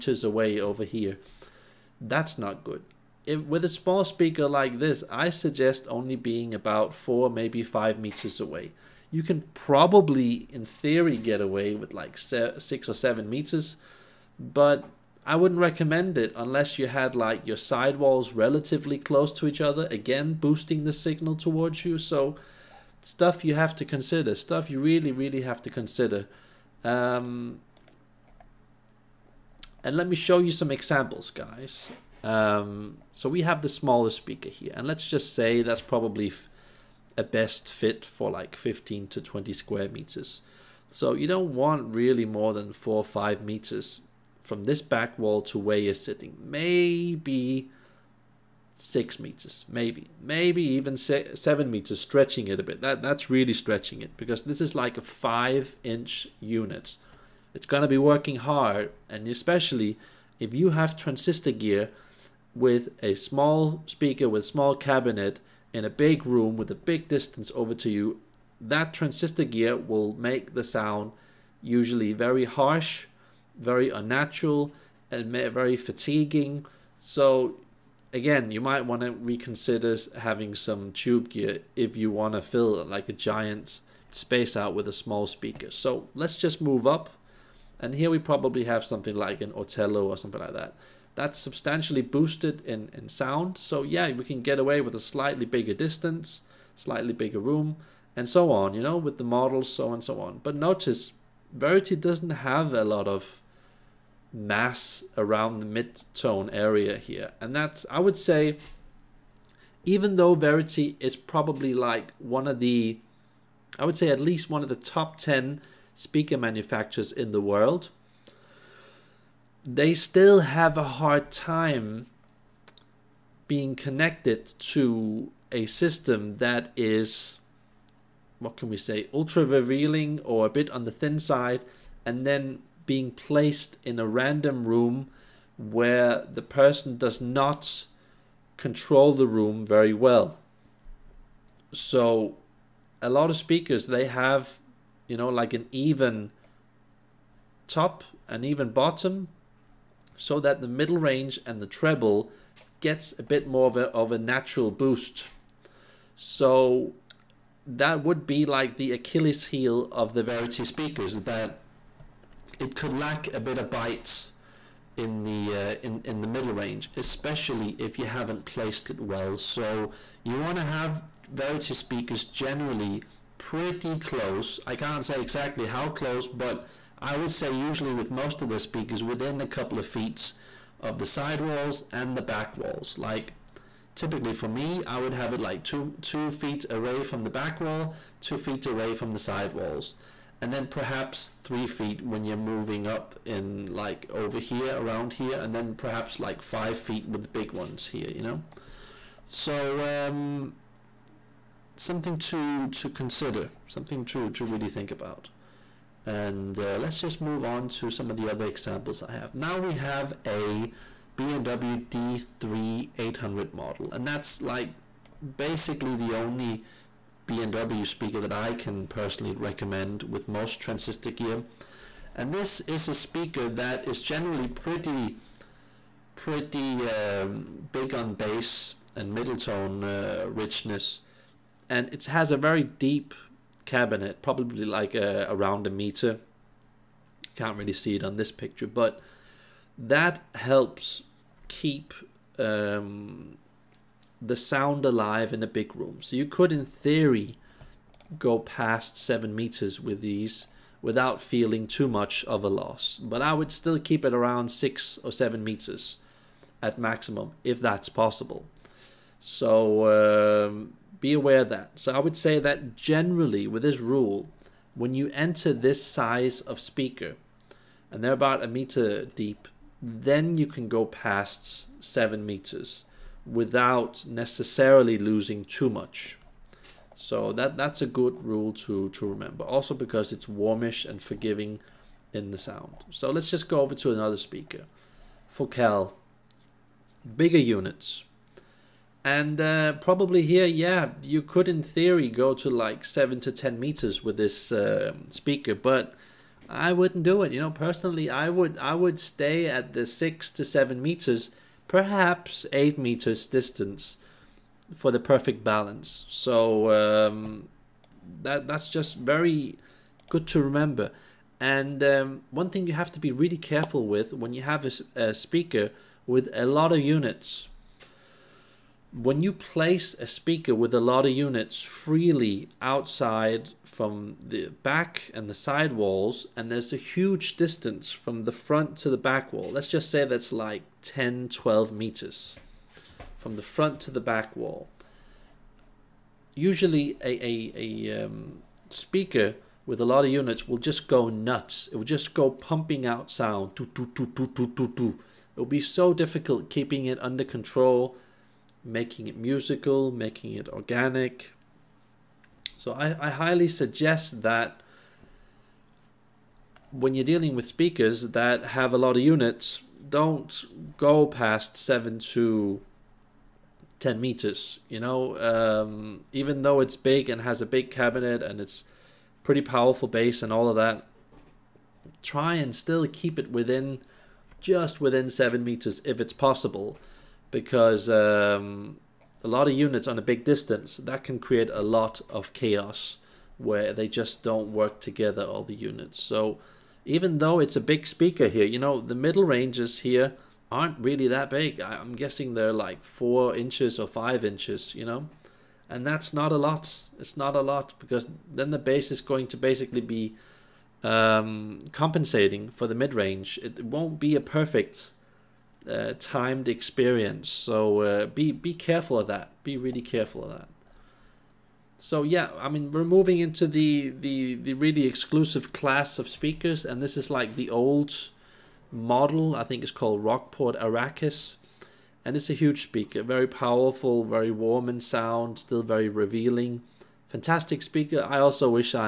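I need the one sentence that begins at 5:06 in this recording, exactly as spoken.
So um, that that's just very good to remember.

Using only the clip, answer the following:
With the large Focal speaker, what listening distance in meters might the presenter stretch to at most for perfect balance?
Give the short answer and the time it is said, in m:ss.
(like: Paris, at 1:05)
8 meters, at 5:02.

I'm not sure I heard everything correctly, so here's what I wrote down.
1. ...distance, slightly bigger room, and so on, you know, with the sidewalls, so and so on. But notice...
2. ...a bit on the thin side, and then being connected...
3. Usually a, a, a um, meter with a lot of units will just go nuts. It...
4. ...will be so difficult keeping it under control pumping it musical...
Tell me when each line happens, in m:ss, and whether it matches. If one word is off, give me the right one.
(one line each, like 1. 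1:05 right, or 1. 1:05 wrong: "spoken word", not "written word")
1. 1:35 wrong: "models", not "sidewalls"
2. 2:10 wrong: "placed", not "connected"
3. 5:36 wrong: "speaker", not "meter"
4. 5:45 wrong: "making", not "pumping".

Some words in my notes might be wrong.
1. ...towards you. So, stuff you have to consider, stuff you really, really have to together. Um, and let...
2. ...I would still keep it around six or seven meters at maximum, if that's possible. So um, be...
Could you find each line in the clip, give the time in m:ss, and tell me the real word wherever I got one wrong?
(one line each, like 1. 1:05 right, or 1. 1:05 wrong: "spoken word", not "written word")
1. 0:21 wrong: "consider", not "together"
2. 4:13 right.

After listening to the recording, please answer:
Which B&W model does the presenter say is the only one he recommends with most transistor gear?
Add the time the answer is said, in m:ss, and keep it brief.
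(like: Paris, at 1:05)
D3 800, at 3:31.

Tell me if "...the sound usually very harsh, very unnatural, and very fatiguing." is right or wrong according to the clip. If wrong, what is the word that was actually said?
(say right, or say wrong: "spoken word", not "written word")
right.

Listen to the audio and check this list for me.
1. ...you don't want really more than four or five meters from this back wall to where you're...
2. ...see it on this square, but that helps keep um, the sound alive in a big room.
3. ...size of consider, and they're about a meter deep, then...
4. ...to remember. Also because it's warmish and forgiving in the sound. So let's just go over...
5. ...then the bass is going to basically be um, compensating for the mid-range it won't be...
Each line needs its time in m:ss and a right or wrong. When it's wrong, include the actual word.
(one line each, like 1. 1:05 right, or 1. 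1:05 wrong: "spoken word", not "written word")
1. 0:41 right
2. 3:57 wrong: "picture", not "square"
3. 4:25 wrong: "speaker", not "consider"
4. 4:38 right
5. 6:38 right.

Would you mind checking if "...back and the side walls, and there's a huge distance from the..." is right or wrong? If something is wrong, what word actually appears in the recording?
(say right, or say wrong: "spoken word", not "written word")
right.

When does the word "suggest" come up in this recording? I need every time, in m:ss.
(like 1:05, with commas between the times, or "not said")
0:05, 5:53.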